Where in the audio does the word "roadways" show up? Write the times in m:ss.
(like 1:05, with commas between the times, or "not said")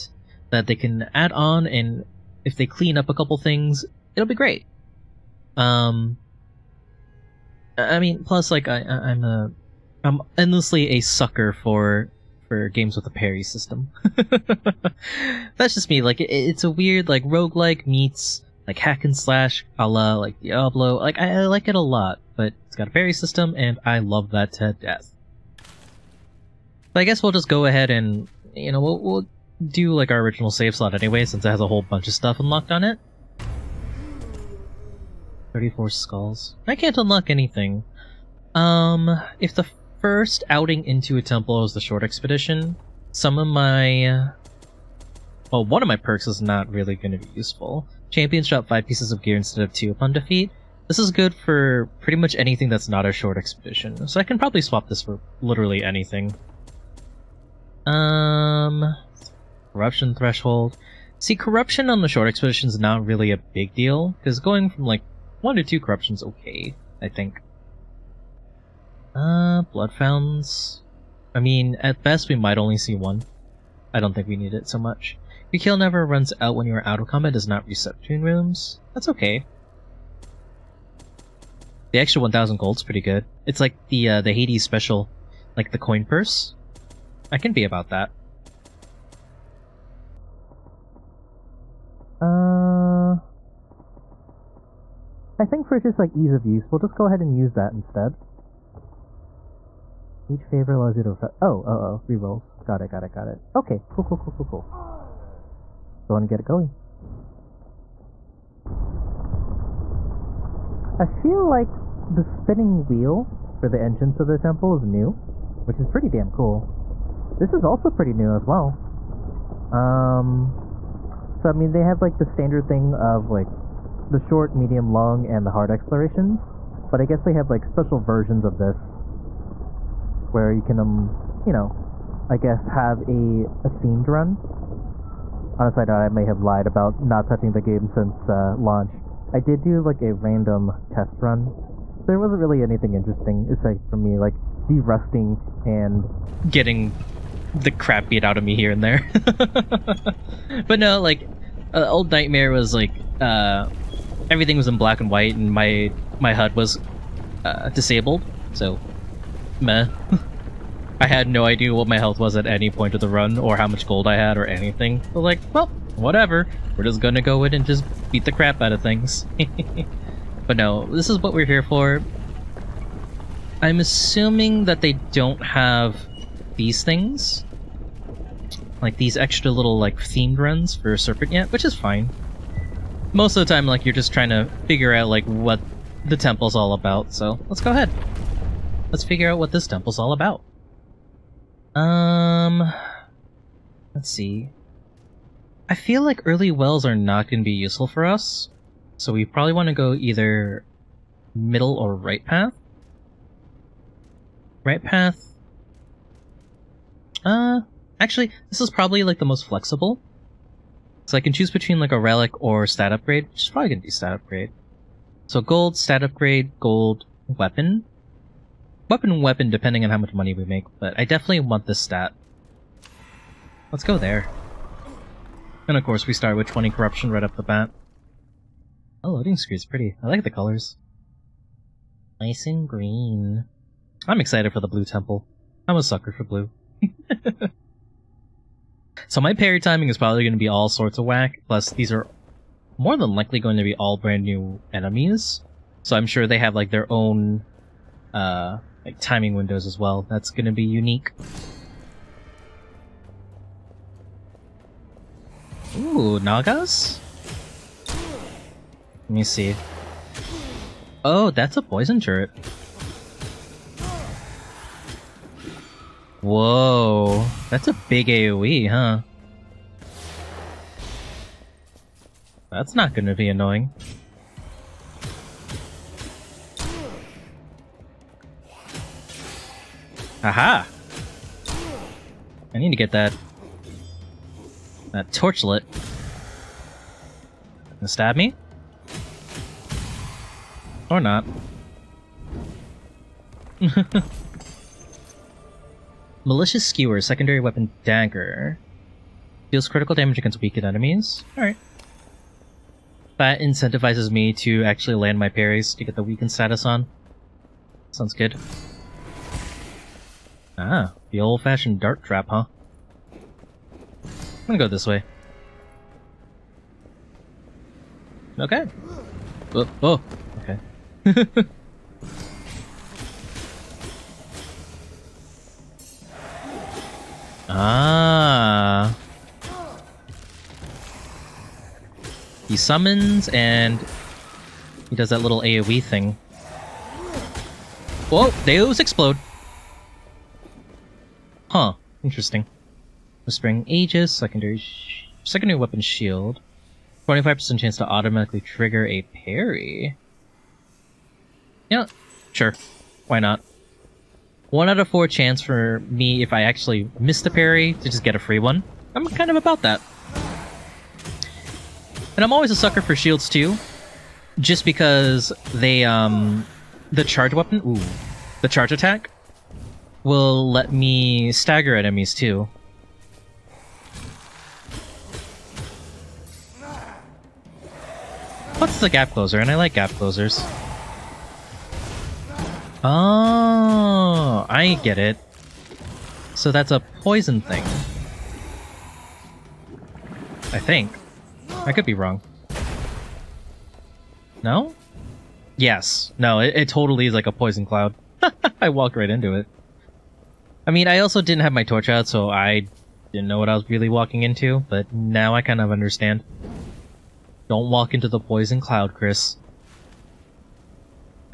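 not said.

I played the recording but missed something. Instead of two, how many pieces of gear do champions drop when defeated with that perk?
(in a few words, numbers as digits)
5.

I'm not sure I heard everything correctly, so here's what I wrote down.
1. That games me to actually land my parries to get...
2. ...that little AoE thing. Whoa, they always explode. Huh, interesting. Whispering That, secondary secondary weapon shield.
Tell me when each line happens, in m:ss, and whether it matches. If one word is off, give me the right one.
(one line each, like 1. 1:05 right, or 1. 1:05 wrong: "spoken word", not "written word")
1. 5:03 wrong: "incentivizes", not "games"
2. 5:35 wrong: "Aegis", not "That".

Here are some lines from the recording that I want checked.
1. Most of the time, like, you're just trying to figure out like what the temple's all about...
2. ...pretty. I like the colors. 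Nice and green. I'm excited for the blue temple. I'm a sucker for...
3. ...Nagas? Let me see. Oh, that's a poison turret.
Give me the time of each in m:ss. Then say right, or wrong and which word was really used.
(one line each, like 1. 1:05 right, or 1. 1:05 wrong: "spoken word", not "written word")
1. 3:03 right
2. 3:49 right
3. 4:16 right.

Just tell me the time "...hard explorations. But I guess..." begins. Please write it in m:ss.
2:05.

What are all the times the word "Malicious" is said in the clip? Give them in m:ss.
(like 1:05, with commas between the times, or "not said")
4:56.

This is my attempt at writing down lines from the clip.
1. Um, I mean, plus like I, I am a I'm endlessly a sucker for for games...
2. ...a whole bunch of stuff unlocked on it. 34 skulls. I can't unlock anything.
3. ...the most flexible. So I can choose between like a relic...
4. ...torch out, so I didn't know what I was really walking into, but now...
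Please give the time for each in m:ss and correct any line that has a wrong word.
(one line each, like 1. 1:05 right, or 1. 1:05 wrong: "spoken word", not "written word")
1. 0:05 right
2. 0:31 right
3. 3:29 right
4. 6:41 right.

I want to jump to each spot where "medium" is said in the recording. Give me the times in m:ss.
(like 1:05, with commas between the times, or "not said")
2:04.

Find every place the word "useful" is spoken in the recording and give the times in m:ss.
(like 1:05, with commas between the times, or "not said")
0:47, 3:17.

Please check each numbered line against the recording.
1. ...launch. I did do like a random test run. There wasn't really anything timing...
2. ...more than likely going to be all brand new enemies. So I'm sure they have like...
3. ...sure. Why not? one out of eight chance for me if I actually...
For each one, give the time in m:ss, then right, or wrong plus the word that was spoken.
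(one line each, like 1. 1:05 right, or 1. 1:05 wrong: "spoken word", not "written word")
1. 2:18 wrong: "interesting", not "timing"
2. 4:02 right
3. 5:52 wrong: "four", not "eight".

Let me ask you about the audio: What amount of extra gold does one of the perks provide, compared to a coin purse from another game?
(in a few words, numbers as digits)
1,000.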